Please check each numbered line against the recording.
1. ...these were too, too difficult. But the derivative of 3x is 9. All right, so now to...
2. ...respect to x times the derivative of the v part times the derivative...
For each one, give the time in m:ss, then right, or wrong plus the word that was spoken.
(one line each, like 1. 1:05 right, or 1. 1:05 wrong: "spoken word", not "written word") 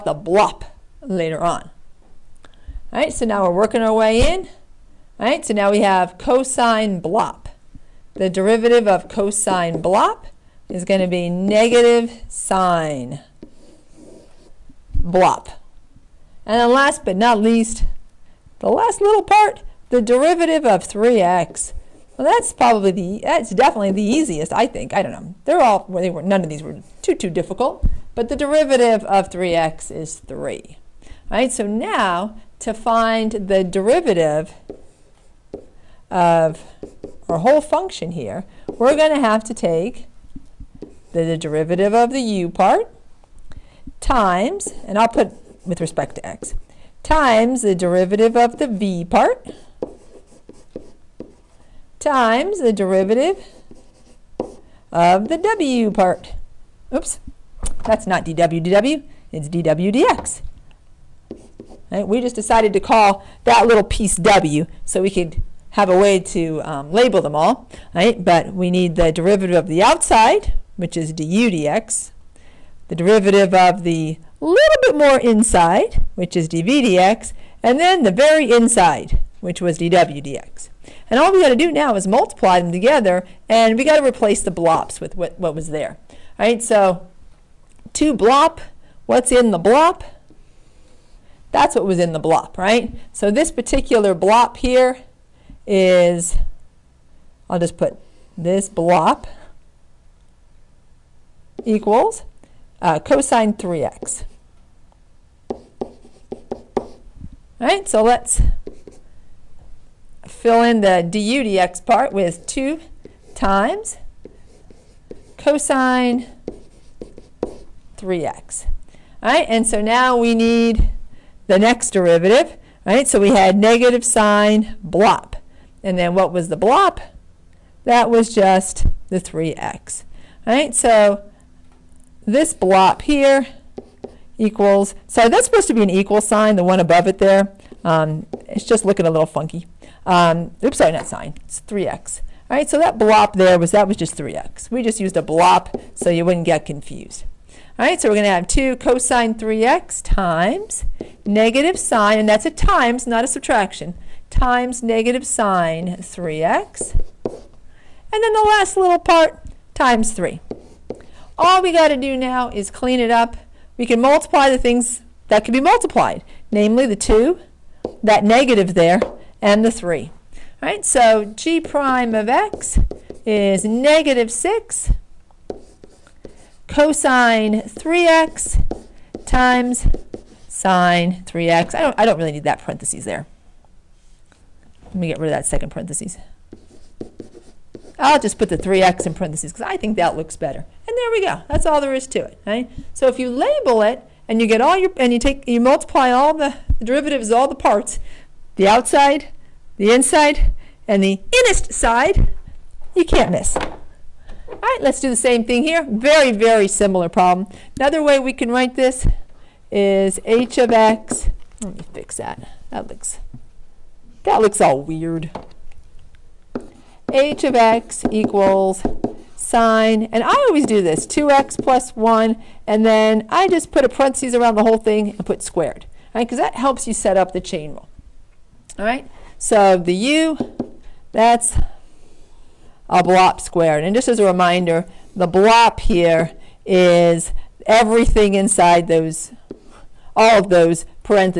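1. 0:26 wrong: "3", not "9"
2. 0:45 right.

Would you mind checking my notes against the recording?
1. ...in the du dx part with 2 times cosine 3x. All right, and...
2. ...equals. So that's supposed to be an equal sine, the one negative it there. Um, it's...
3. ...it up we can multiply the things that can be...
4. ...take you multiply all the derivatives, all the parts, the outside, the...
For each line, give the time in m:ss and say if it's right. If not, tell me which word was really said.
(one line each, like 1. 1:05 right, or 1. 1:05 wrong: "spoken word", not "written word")
1. 1:50 right
2. 2:14 wrong: "above", not "negative"
3. 2:42 right
4. 3:15 right.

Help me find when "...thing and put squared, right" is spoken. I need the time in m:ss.
3:44.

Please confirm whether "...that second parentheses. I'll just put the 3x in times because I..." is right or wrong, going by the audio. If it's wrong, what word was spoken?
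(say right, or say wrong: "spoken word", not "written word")
wrong: "parentheses", not "times".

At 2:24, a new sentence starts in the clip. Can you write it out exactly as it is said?
We just used a blop so you wouldn't get confused.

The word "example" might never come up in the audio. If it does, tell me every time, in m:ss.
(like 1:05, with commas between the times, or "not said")
not said.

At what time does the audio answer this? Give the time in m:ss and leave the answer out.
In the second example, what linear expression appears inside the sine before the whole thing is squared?
3:41.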